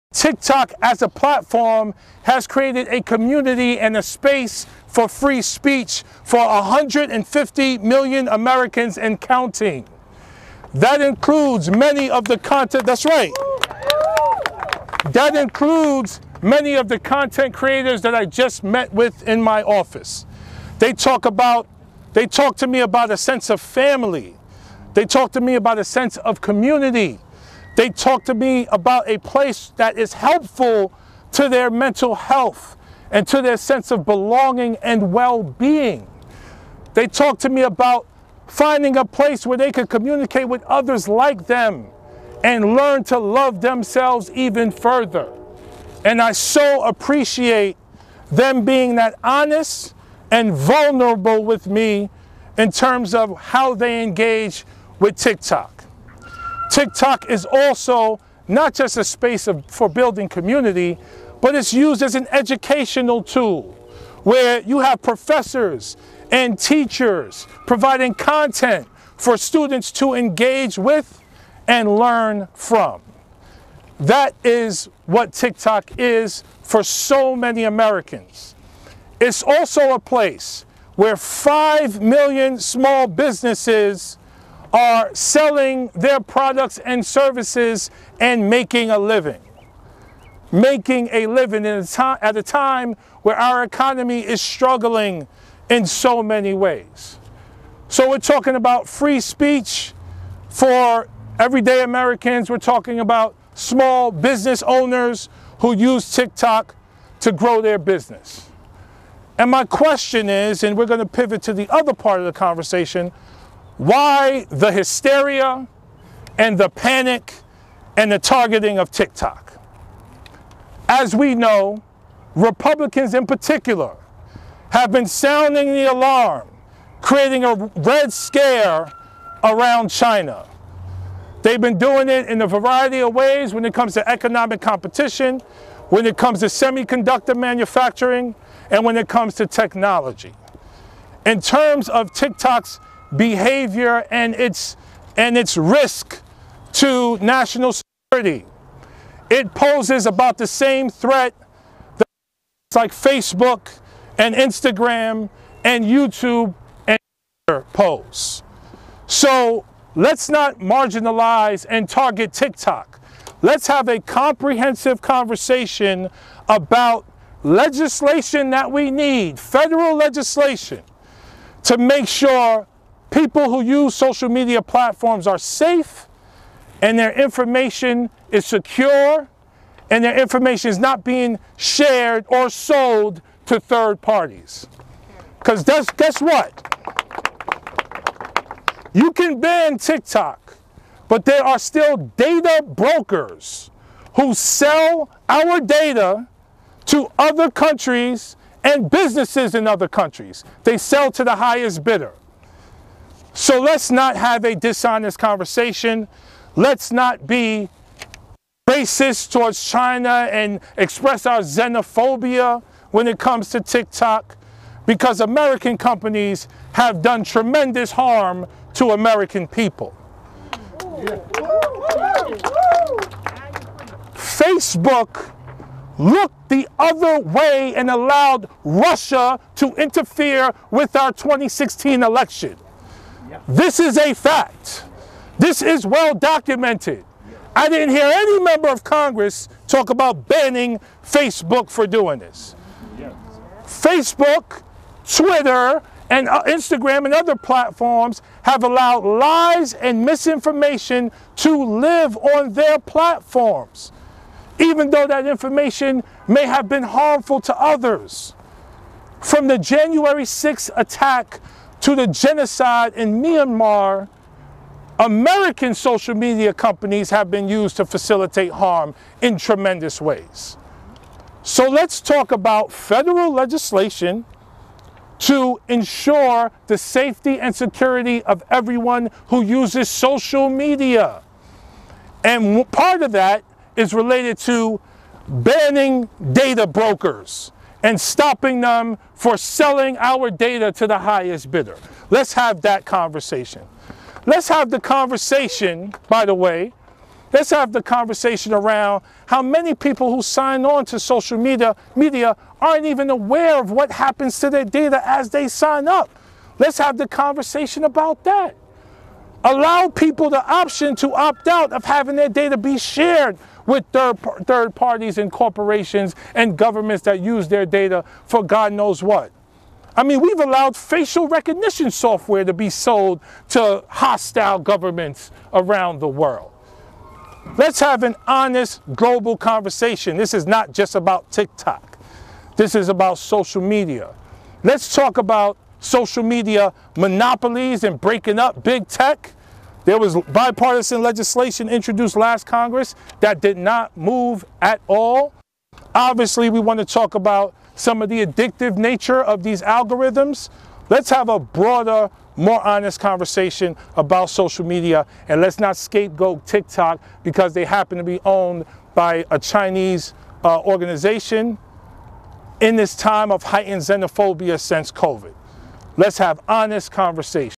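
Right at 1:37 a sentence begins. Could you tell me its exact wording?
So we're talking about free speech for everyday Americans.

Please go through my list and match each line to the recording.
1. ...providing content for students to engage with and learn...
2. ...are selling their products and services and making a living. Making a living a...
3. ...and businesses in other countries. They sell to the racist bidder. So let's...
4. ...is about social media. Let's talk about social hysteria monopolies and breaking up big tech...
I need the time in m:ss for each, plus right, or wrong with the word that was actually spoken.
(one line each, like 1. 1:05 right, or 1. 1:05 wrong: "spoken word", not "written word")
1. 1:07 right
2. 1:24 right
3. 3:18 wrong: "highest", not "racist"
4. 5:32 wrong: "media", not "hysteria".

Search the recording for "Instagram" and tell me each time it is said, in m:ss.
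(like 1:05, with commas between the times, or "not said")
2:34, 4:06.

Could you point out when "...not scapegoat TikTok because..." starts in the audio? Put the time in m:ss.
5:55.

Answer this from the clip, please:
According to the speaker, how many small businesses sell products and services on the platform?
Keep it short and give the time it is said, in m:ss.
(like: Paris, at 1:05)
5 million, at 1:21.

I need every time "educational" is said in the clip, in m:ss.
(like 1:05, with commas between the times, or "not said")
1:02.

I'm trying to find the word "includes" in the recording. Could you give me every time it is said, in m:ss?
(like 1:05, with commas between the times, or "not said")
0:10, 0:15.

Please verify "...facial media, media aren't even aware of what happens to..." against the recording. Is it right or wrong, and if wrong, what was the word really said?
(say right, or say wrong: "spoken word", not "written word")
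wrong: "social", not "facial".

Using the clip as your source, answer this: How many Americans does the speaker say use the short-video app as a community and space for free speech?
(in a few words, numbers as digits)
150 million.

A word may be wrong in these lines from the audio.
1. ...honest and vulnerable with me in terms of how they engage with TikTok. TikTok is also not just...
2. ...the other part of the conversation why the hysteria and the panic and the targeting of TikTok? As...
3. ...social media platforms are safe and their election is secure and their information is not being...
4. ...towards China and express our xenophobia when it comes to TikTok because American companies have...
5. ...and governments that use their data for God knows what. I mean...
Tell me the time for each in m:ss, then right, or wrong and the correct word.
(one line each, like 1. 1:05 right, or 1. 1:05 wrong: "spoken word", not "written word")
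1. 0:49 right
2. 1:51 right
3. 2:53 wrong: "information", not "election"
4. 3:29 right
5. 5:16 right.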